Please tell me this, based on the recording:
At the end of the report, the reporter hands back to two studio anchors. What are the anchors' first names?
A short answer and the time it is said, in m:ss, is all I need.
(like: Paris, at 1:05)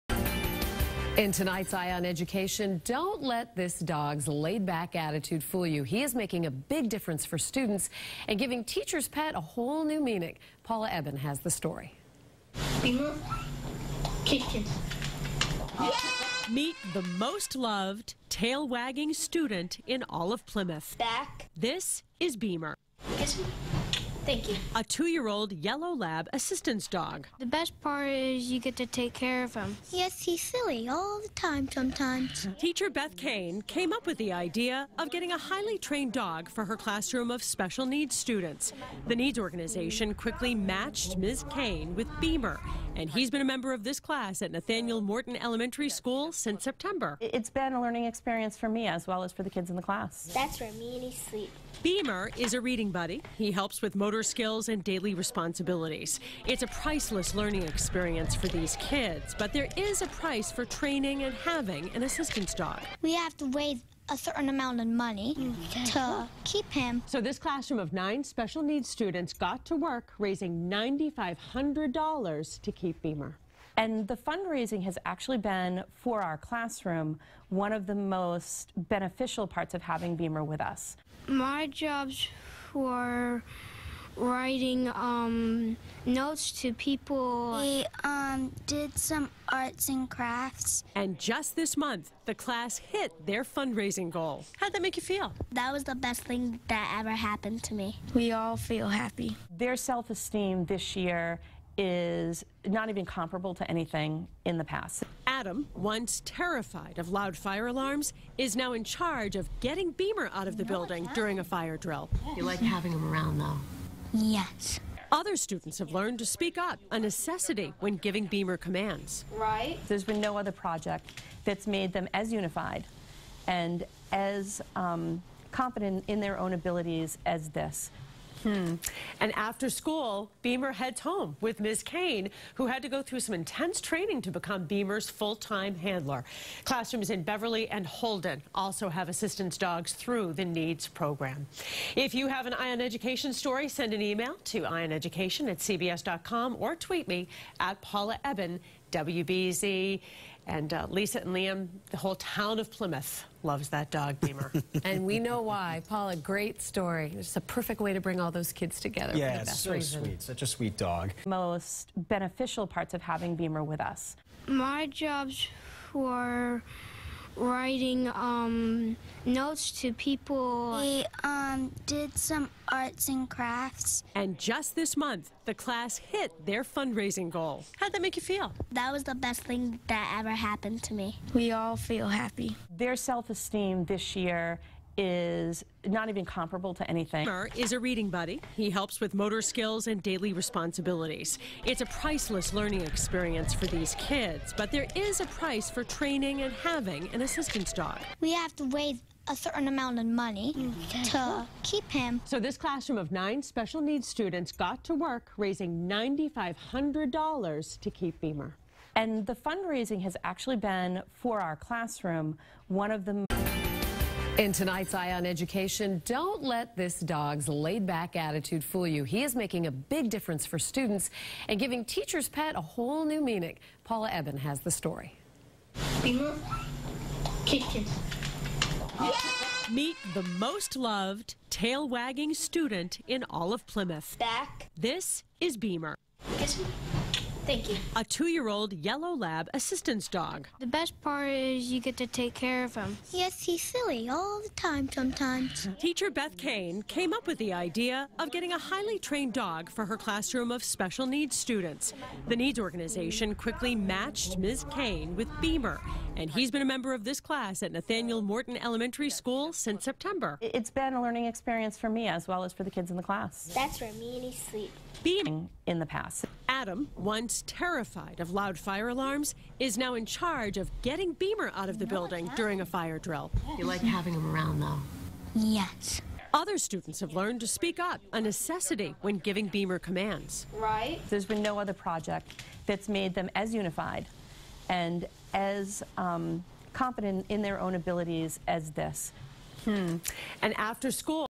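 Lisa and Liam, at 2:30.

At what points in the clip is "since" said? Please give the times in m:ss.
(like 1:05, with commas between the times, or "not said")
0:46, 4:19.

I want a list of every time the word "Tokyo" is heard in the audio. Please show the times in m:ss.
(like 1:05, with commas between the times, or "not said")
not said.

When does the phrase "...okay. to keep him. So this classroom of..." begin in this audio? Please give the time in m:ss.
3:20.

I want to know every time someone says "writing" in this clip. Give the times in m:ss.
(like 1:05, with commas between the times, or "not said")
1:24, 2:47.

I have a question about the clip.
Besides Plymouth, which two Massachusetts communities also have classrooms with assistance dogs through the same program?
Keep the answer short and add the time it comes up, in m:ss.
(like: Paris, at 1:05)
Beverly and Holden, at 2:17.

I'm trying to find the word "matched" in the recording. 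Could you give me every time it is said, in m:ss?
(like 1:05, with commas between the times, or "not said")
0:40, 4:13.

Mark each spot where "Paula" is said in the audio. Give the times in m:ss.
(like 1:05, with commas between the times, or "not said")
0:10, 2:27, 2:35, 3:43.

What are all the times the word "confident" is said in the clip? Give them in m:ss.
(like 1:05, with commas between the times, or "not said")
2:05, 4:46.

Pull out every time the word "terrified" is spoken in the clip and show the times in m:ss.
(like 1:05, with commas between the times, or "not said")
1:46, 4:27.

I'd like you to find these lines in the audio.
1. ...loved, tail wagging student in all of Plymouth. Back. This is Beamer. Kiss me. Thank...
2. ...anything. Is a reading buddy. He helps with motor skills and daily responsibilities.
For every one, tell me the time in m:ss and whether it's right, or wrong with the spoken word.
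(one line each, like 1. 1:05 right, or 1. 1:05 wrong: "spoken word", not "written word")
1. 0:17 right
2. 3:06 right.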